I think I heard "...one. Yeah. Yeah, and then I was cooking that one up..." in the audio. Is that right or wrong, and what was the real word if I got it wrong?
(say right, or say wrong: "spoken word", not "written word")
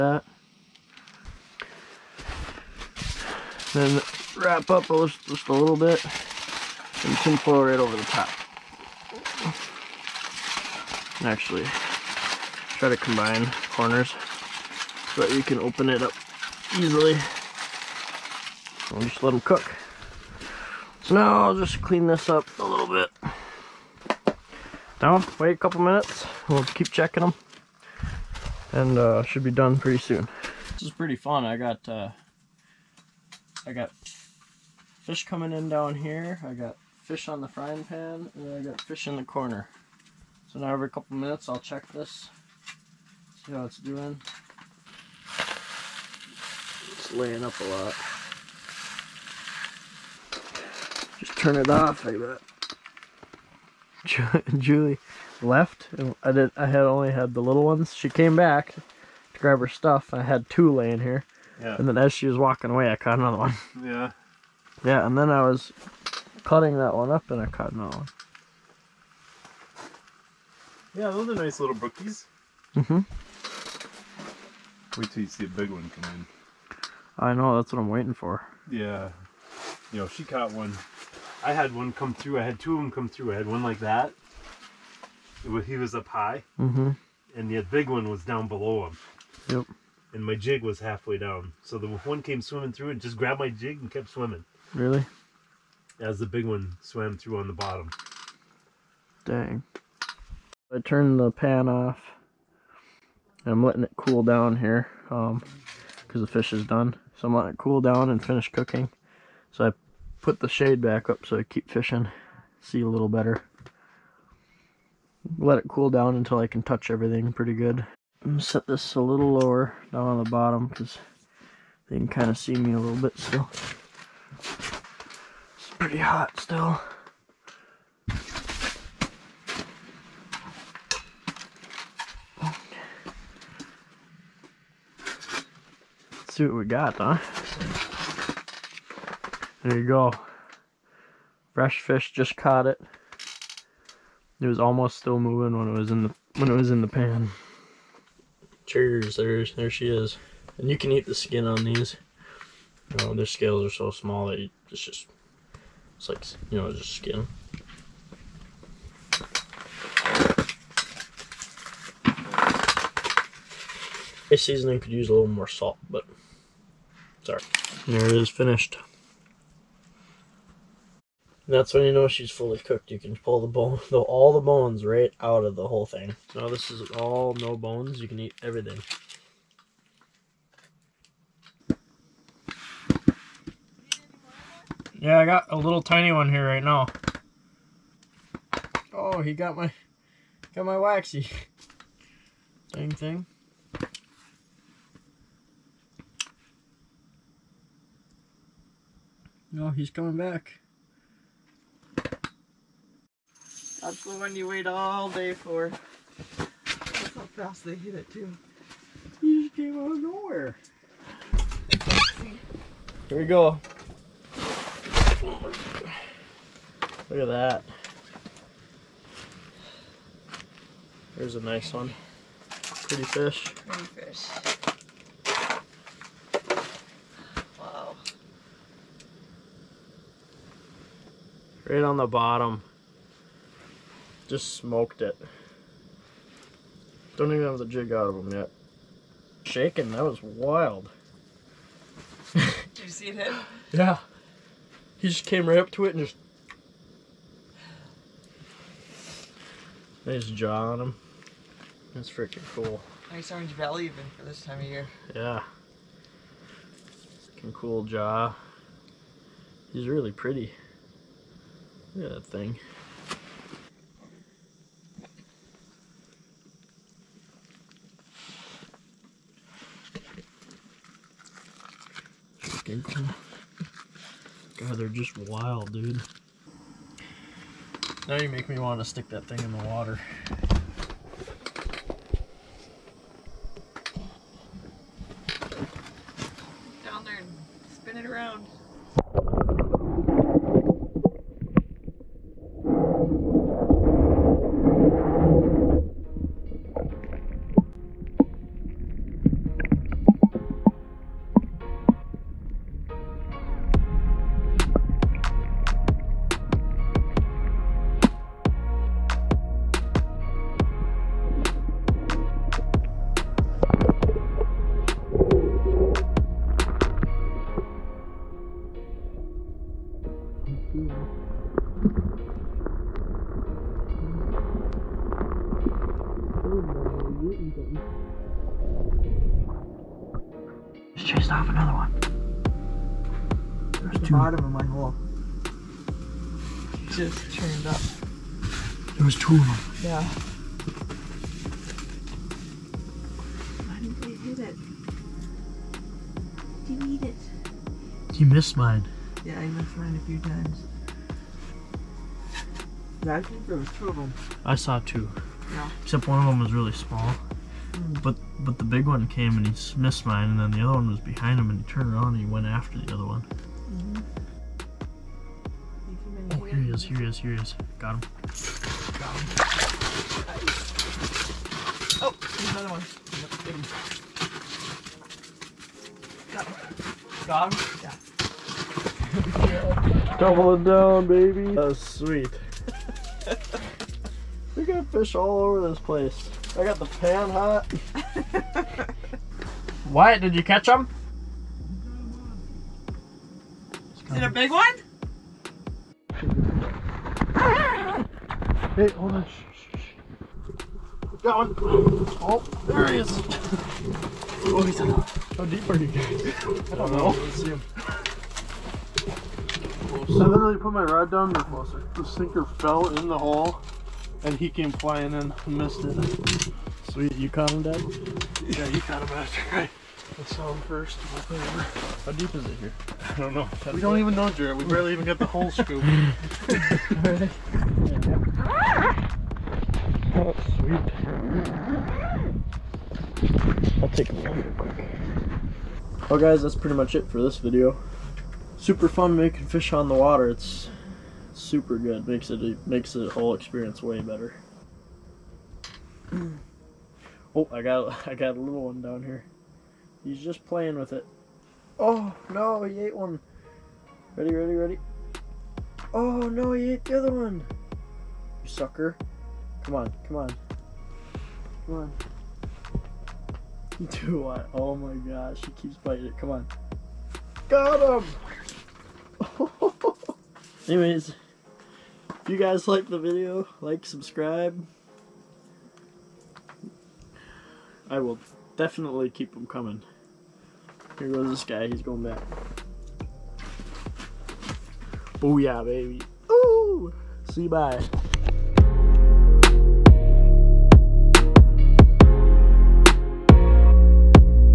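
wrong: "cutting", not "cooking".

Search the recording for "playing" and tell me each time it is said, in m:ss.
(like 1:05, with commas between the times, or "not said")
7:30.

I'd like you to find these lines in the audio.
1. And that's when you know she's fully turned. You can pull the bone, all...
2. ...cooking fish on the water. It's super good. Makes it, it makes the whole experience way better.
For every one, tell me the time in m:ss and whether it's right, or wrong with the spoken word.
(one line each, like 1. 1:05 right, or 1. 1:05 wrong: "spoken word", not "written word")
1. 2:51 wrong: "cooked", not "turned"
2. 7:19 wrong: "making", not "cooking".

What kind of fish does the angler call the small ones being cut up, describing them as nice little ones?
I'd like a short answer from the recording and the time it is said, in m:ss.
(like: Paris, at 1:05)
brookies, at 1:11.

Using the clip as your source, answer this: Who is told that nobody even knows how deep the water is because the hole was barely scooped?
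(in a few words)
Jaret.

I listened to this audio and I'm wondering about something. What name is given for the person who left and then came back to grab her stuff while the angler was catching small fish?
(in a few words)
Julie.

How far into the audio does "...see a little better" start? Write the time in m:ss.
1:52.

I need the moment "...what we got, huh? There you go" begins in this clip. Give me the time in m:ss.
2:16.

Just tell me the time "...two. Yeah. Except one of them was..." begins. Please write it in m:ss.
5:54.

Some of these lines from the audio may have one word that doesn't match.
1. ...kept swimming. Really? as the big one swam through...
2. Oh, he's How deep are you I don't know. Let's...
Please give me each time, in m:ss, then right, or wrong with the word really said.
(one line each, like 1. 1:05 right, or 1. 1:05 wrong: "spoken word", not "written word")
1. 1:33 right
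2. 6:44 right.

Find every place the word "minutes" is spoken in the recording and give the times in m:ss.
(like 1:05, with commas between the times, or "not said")
0:25, 0:41.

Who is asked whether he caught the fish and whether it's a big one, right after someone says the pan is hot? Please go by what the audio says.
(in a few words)
Wyatt.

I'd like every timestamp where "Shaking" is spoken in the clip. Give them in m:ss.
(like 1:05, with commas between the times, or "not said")
3:59.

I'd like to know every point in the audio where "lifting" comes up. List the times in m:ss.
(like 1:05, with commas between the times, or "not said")
not said.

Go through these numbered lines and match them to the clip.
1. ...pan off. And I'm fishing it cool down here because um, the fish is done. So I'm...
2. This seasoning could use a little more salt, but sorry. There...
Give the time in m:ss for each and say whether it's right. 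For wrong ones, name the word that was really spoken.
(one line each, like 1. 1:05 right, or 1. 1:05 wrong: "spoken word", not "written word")
1. 1:41 wrong: "letting", not "fishing"
2. 2:44 right.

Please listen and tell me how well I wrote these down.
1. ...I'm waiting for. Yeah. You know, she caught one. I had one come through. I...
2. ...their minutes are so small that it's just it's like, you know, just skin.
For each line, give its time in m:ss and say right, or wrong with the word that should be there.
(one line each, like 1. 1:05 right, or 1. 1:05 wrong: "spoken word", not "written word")
1. 1:17 right
2. 2:33 wrong: "scales", not "minutes".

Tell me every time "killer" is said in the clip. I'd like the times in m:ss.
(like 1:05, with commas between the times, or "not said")
not said.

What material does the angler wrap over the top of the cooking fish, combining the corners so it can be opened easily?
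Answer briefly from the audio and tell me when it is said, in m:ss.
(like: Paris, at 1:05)
tin foil, at 0:07.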